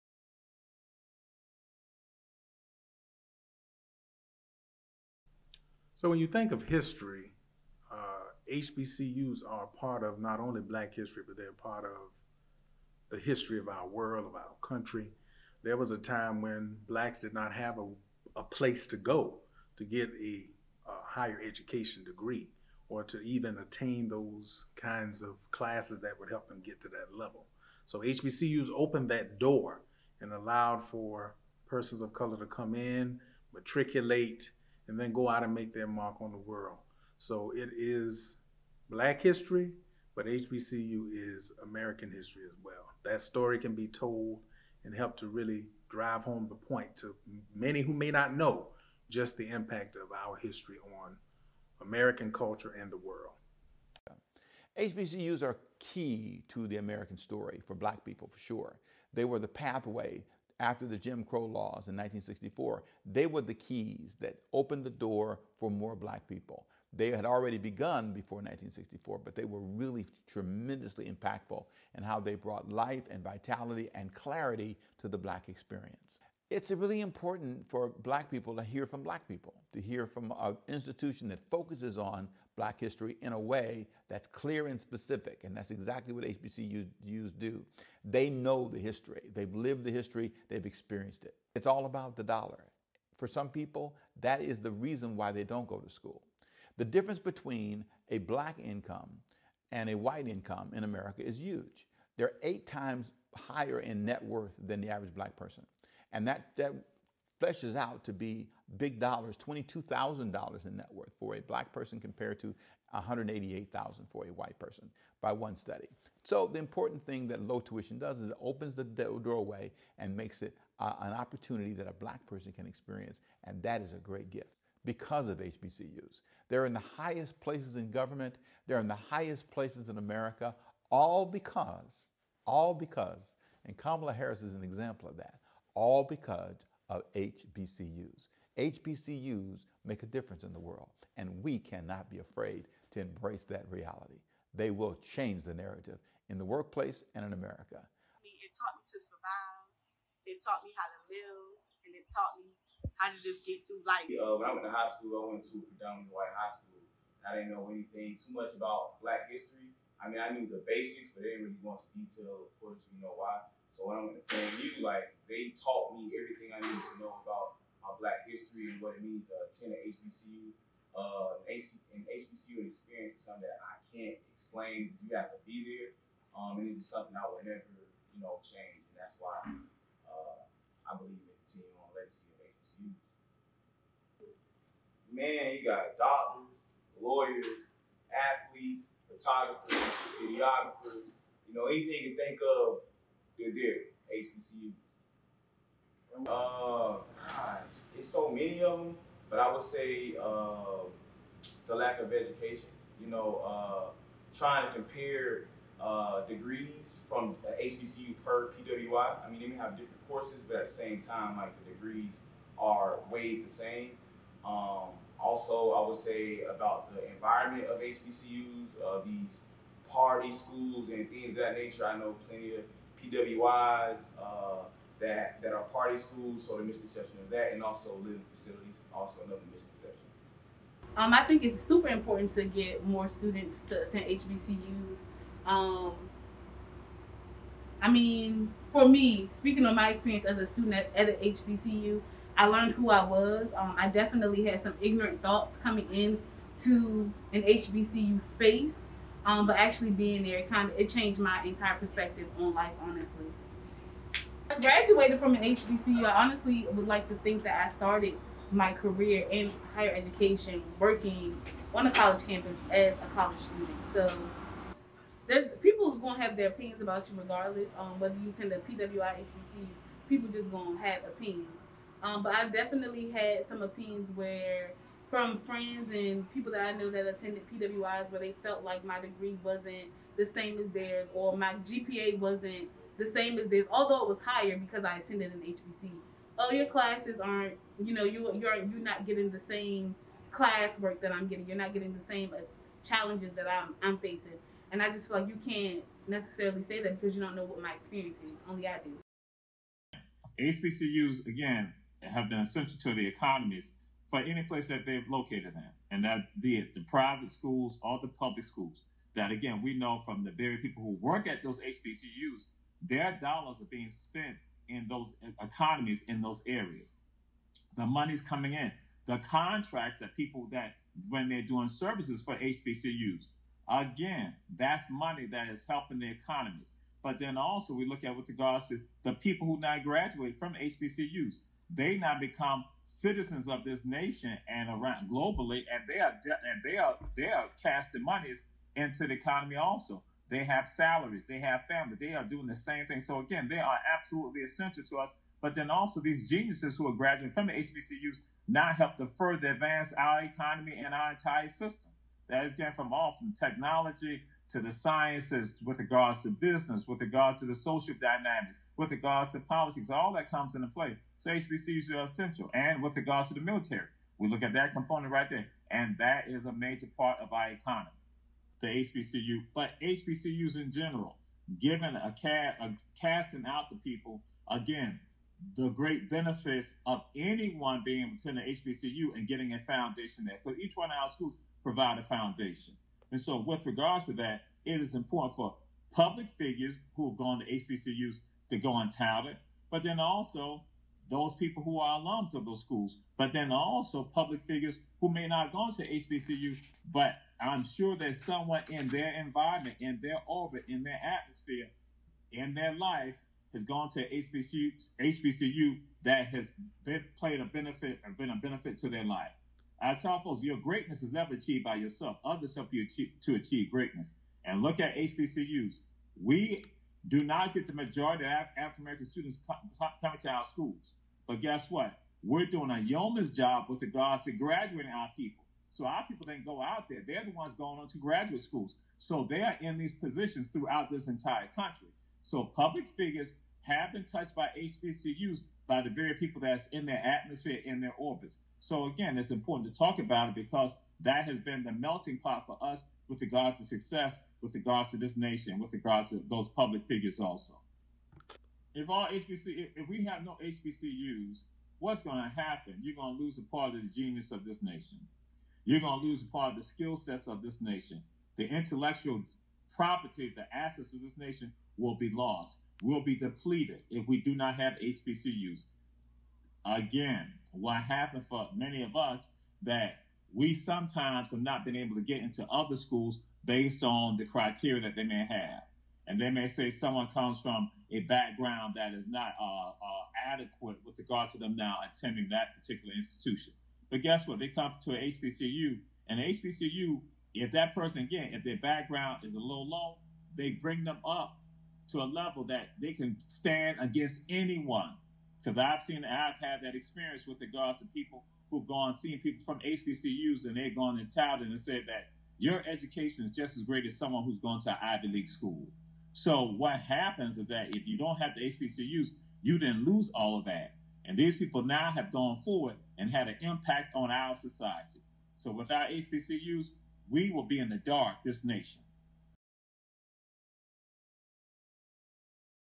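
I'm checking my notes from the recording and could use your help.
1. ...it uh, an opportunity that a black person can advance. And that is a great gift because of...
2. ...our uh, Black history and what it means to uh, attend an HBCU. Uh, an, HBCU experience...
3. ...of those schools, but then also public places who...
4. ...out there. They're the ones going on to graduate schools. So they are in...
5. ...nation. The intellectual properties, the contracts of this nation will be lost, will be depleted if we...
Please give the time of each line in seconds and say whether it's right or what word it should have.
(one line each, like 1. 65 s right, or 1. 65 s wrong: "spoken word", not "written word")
1. 120 s wrong: "experience", not "advance"
2. 167 s right
3. 392 s wrong: "figures", not "places"
4. 426 s right
5. 457 s wrong: "assets", not "contracts".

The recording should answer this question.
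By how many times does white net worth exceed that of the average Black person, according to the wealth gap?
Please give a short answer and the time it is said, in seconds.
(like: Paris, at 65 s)
8, at 102 s.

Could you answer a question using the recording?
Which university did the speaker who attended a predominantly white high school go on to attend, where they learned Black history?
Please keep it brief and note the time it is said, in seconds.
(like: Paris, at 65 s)
FAMU, at 164 s.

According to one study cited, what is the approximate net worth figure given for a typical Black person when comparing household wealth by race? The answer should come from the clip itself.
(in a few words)
$22,000.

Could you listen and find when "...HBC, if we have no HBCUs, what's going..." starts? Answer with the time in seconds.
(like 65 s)
449 s.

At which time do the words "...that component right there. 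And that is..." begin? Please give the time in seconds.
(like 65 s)
364 s.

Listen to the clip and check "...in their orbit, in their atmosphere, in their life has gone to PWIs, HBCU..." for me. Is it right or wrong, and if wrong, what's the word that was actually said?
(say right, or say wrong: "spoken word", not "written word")
wrong: "HBCU", not "PWIs".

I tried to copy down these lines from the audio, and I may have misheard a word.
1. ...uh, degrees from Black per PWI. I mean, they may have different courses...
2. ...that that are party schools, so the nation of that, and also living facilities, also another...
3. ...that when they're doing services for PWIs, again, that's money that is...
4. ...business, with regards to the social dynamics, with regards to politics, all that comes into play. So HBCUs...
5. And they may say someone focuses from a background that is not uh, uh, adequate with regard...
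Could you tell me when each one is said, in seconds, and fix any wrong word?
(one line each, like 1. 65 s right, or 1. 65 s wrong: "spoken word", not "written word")
1. 205 s wrong: "HBCU", not "Black"
2. 224 s wrong: "misconception", not "nation"
3. 320 s wrong: "HBCUs", not "PWIs"
4. 356 s right
5. 476 s wrong: "comes", not "focuses".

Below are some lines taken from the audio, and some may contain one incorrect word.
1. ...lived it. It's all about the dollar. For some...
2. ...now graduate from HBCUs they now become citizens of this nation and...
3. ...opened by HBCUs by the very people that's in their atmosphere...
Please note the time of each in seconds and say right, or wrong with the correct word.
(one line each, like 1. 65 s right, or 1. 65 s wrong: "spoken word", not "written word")
1. 90 s wrong: "experienced", not "lived"
2. 329 s right
3. 434 s wrong: "touched", not "opened".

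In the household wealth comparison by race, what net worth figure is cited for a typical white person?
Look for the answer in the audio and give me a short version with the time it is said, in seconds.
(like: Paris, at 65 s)
188,000, at 112 s.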